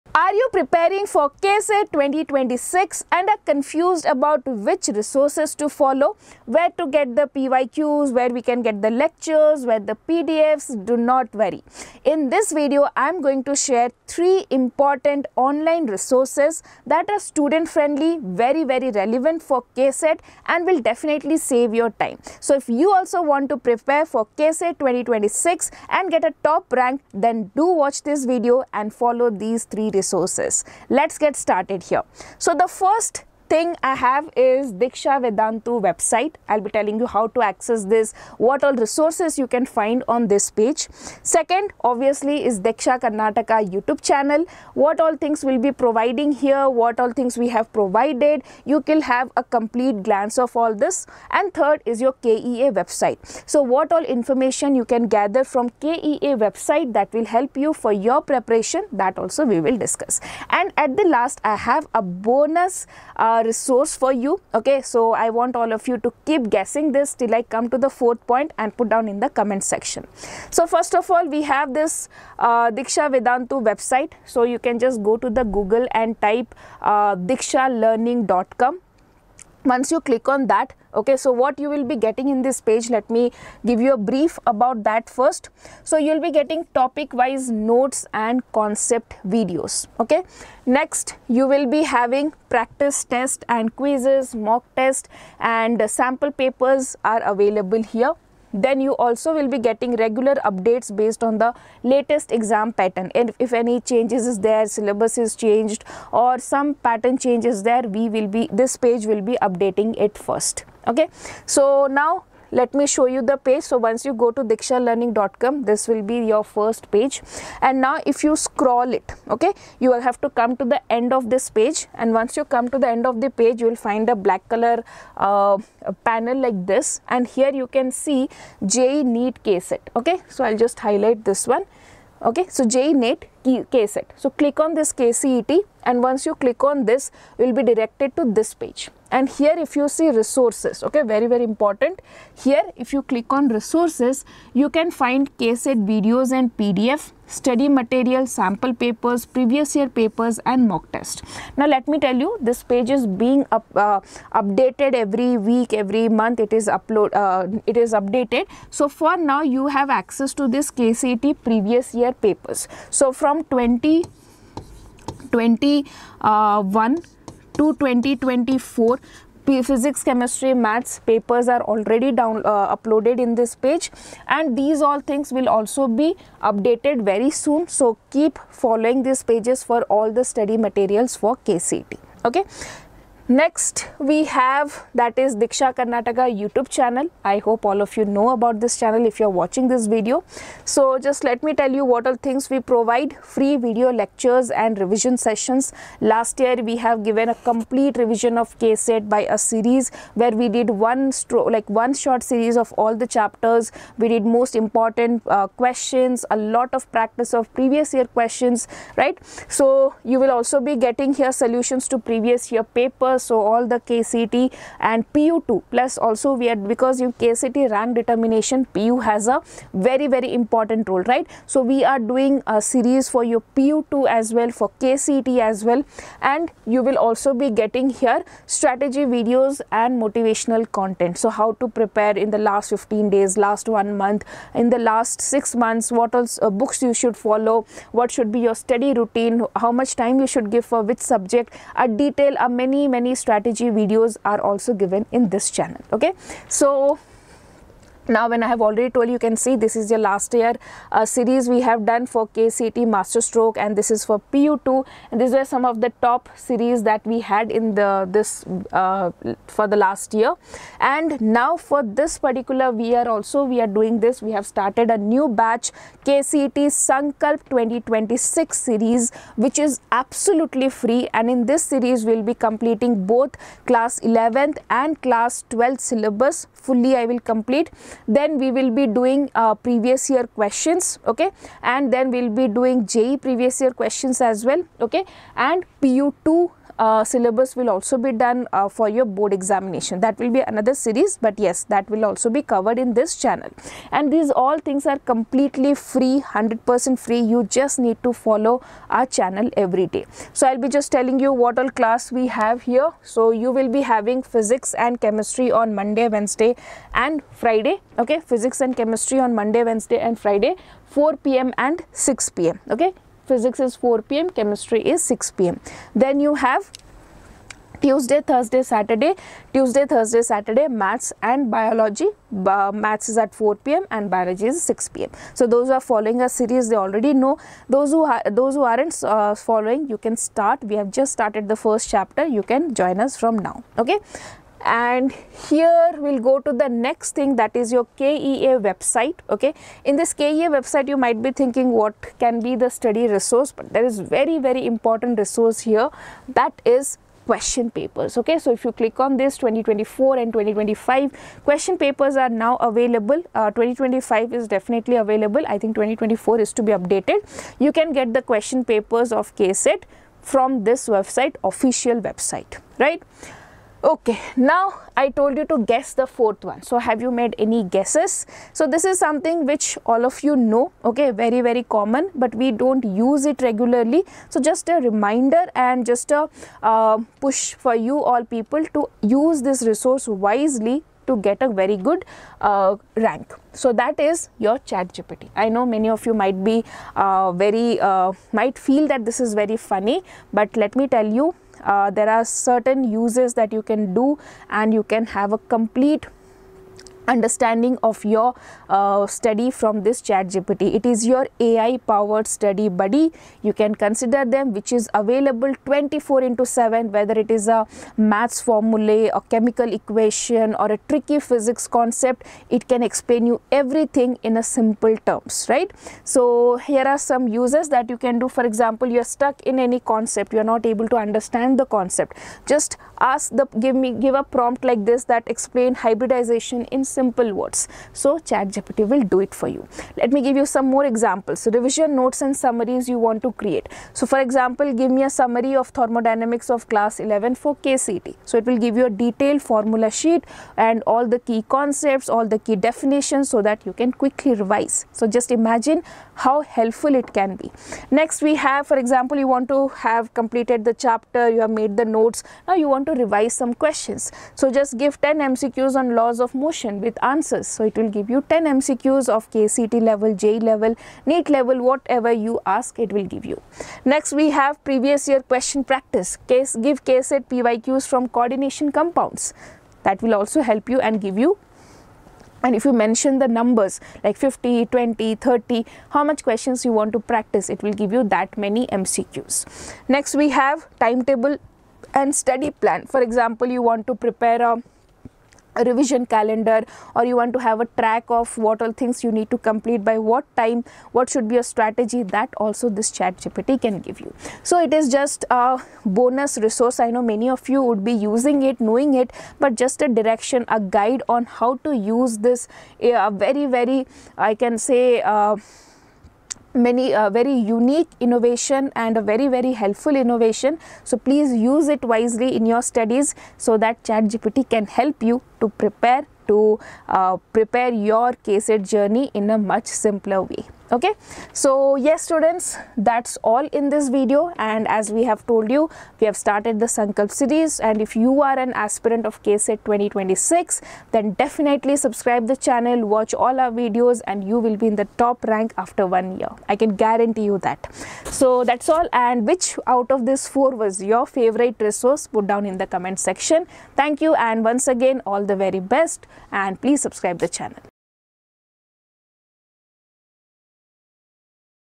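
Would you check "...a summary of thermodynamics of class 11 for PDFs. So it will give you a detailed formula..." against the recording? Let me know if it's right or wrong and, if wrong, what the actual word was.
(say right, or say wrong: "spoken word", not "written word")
wrong: "KCET", not "PDFs".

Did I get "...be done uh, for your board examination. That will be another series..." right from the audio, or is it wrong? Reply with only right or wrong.
right.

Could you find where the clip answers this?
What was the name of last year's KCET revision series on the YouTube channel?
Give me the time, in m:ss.
4:12.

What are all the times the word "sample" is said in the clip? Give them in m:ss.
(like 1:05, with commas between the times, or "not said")
1:35, 2:28.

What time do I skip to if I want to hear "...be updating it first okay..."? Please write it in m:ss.
1:49.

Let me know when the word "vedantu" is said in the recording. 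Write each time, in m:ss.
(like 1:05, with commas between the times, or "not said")
0:35, 1:13.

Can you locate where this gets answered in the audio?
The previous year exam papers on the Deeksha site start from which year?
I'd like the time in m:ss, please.
2:43.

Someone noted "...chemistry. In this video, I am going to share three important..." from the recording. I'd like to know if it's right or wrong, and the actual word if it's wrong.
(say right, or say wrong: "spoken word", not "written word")
wrong: "worry", not "chemistry".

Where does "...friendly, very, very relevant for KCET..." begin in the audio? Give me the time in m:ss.
0:17.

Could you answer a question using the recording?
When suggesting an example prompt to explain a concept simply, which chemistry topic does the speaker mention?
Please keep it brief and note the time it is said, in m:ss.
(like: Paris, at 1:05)
Hybridization, at 7:05.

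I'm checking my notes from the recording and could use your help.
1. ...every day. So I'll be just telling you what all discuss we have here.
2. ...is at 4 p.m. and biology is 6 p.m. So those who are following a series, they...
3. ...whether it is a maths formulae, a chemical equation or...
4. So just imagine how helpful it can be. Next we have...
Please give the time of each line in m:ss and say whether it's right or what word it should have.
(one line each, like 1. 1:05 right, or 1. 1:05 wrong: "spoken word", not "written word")
1. 4:59 wrong: "class", not "discuss"
2. 5:23 right
3. 6:46 right
4. 7:25 right.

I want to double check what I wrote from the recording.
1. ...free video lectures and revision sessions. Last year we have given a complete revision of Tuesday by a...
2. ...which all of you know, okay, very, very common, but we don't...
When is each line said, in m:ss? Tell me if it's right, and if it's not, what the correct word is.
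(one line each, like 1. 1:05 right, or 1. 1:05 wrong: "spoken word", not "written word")
1. 3:13 wrong: "KCET", not "Tuesday"
2. 6:09 right.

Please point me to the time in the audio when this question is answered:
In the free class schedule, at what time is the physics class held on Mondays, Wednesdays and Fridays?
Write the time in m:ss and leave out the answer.
5:13.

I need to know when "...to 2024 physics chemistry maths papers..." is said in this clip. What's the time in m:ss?
2:47.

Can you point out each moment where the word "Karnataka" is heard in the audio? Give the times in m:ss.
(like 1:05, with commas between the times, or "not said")
0:43, 3:05.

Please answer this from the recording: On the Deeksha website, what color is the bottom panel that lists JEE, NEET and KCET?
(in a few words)
Black.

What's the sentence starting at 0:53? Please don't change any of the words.
So what all information you can gather from KEA website that will help you for your preparation, that also we will discuss.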